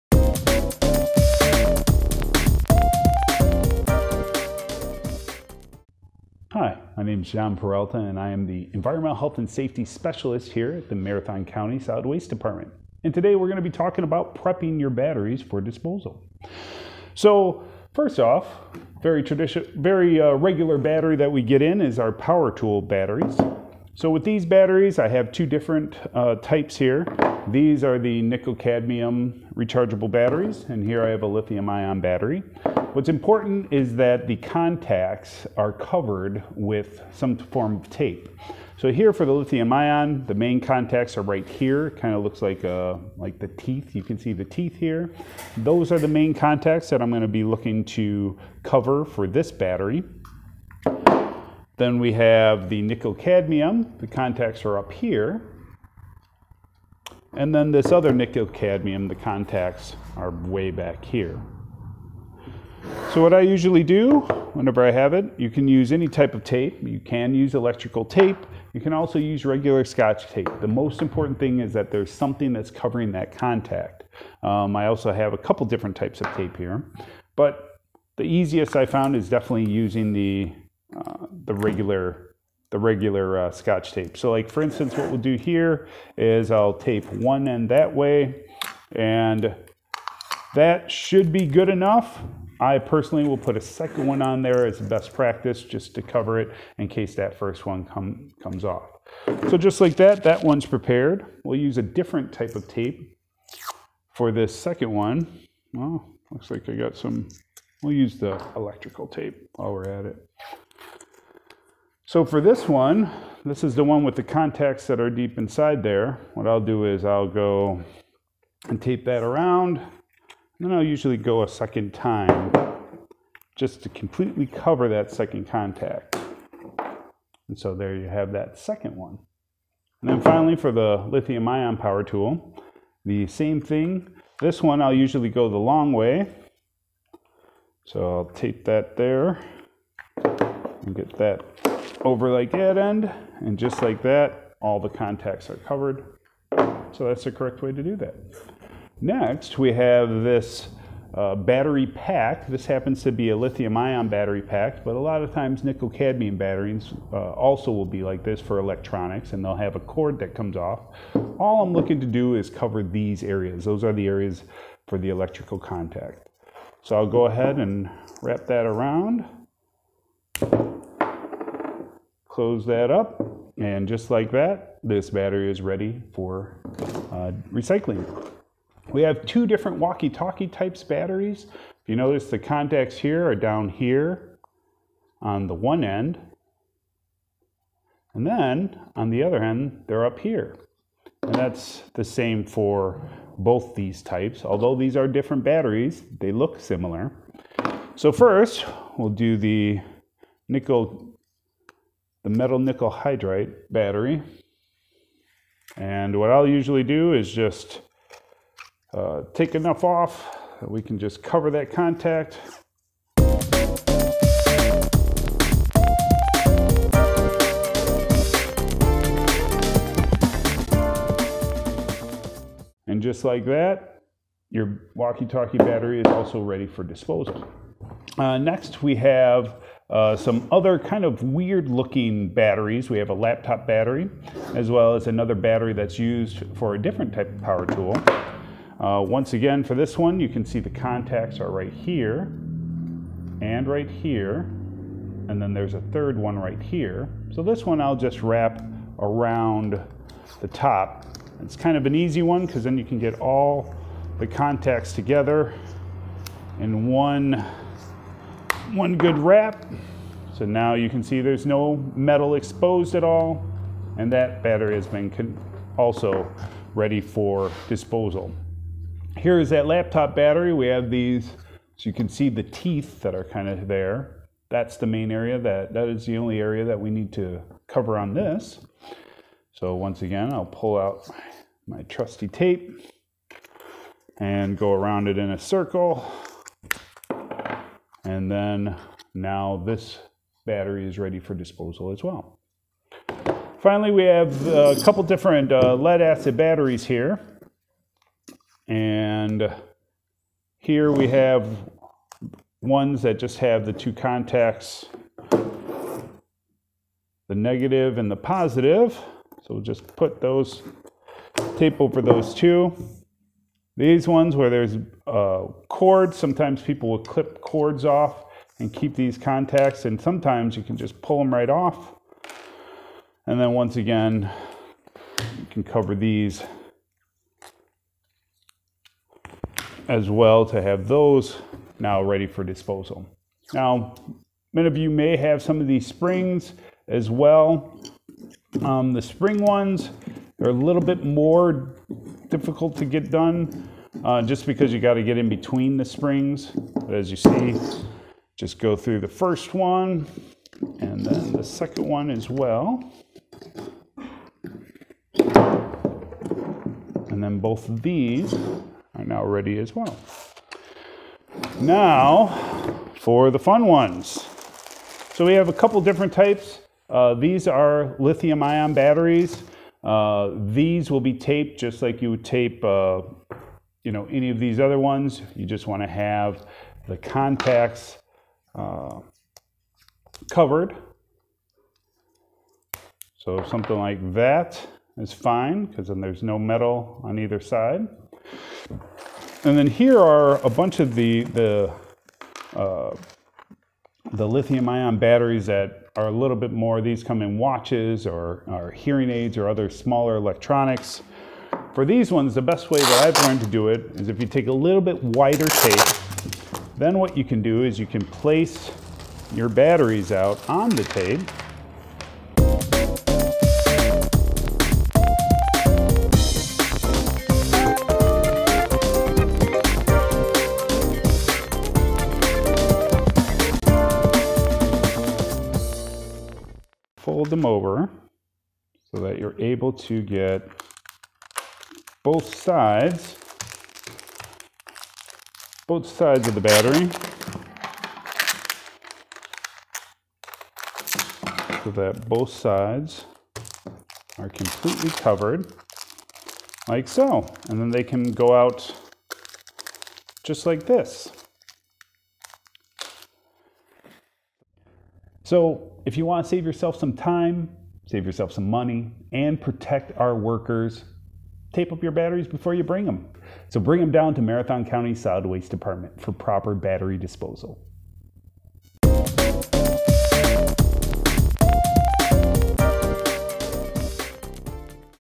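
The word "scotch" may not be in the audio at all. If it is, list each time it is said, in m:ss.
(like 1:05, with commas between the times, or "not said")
1:09, 1:23.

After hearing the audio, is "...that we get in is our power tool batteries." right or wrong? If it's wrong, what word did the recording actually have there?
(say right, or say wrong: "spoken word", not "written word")
right.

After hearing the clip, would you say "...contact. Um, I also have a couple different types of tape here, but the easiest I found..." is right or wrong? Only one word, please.
right.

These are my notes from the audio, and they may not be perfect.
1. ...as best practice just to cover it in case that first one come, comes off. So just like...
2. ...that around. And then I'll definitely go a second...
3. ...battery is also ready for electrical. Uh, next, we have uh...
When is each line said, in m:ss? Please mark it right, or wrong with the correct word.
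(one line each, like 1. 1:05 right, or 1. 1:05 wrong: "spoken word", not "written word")
1. 1:34 right
2. 1:59 wrong: "usually", not "definitely"
3. 3:45 wrong: "disposal", not "electrical".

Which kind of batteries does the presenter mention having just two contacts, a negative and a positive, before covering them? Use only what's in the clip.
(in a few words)
lead acid.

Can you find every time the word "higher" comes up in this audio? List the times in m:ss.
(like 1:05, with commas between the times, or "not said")
not said.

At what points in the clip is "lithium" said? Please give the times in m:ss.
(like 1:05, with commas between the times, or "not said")
0:31, 0:39, 2:11, 2:33, 6:07, 6:34.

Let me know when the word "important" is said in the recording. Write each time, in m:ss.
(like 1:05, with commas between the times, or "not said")
0:33, 1:11.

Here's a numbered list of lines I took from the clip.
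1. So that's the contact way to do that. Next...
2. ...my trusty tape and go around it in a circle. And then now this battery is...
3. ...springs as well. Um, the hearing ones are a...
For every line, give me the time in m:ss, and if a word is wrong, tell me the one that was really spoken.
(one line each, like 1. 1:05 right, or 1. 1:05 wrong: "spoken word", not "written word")
1. 2:26 wrong: "correct", not "contact"
2. 4:41 right
3. 5:35 wrong: "spring", not "hearing".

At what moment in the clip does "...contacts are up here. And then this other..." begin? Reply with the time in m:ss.
0:54.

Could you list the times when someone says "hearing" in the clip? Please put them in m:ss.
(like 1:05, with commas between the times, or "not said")
6:38.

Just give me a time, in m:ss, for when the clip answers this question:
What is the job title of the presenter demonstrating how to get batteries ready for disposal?
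0:08.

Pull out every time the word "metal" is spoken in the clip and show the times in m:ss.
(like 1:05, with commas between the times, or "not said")
3:22, 4:21, 6:26.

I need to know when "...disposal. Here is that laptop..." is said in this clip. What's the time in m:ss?
4:27.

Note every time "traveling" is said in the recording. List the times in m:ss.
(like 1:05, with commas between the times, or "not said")
not said.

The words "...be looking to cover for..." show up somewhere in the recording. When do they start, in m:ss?
0:47.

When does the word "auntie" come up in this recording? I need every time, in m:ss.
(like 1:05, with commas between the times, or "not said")
not said.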